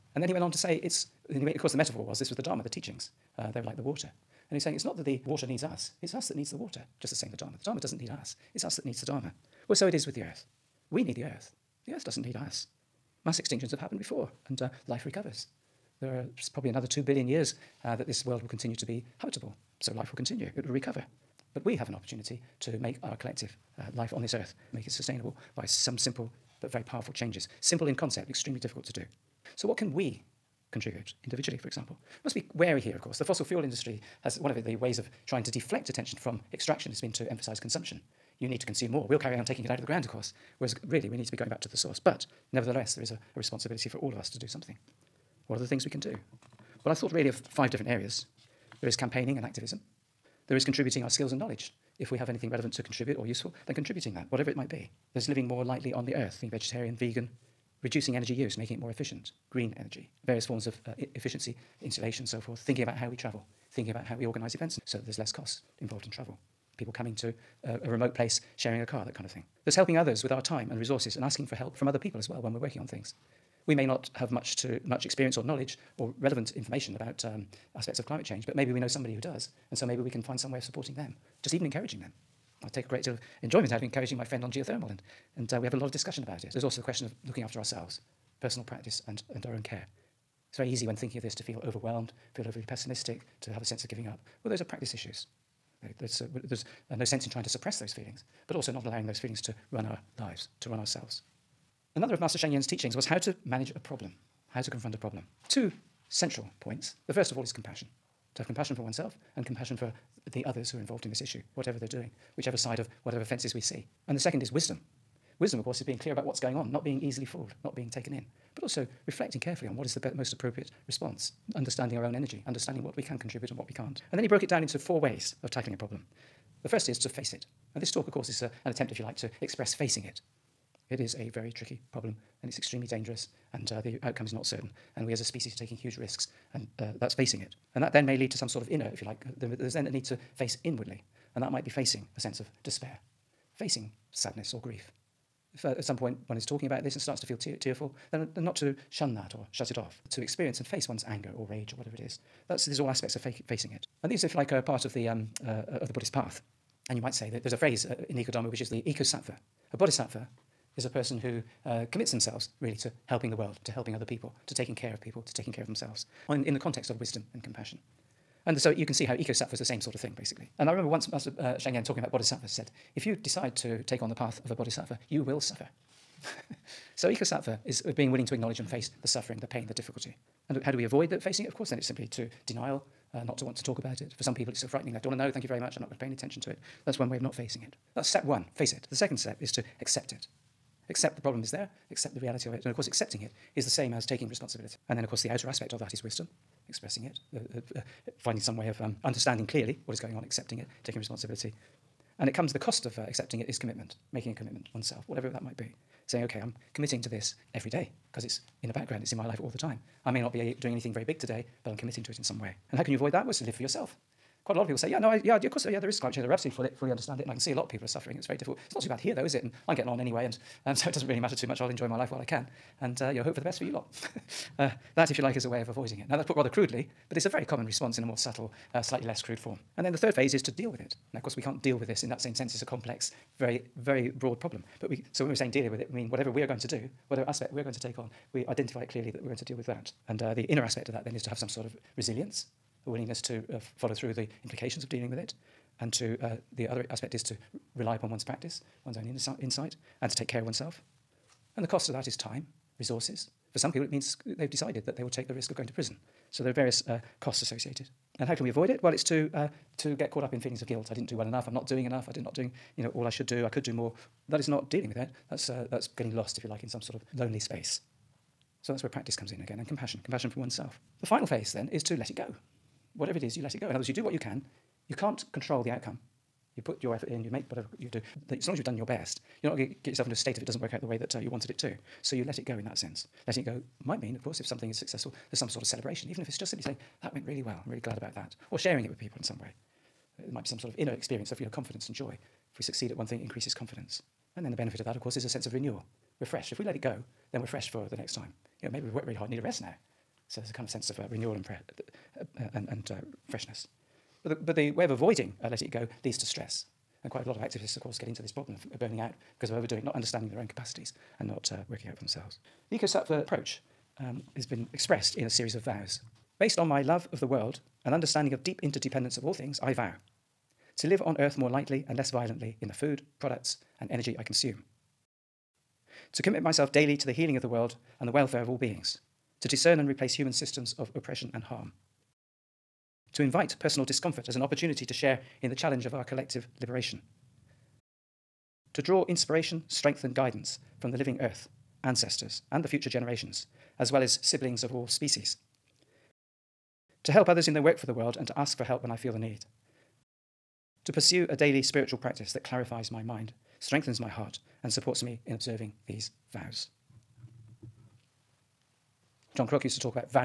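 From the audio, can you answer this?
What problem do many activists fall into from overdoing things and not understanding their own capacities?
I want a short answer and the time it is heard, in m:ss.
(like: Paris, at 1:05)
Burning out, at 5:08.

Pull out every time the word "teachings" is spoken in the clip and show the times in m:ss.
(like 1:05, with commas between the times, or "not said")
0:02, 1:42.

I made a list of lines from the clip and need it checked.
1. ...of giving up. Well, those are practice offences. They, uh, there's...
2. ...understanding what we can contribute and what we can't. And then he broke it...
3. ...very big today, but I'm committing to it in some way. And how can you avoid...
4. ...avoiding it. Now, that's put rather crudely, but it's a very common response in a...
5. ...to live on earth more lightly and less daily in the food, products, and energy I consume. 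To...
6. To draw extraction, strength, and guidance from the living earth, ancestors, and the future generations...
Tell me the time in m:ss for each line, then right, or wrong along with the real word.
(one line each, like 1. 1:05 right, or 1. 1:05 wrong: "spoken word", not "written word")
1. 1:33 wrong: "issues", not "offences"
2. 2:02 right
3. 3:30 right
4. 3:45 right
5. 5:20 wrong: "violently", not "daily"
6. 5:38 wrong: "inspiration", not "extraction".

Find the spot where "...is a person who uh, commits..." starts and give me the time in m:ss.
2:40.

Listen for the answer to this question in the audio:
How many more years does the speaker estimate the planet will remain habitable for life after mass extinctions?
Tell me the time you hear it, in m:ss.
0:16.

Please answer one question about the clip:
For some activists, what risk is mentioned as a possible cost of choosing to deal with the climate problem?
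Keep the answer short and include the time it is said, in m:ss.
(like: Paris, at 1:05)
Going to prison, at 4:15.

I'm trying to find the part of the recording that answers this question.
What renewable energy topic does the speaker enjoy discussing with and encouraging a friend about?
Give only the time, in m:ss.
1:24.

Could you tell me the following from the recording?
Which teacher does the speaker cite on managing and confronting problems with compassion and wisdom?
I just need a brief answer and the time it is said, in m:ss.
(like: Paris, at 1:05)
Master Sheng Yen, at 1:42.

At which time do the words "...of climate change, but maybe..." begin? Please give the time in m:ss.
1:17.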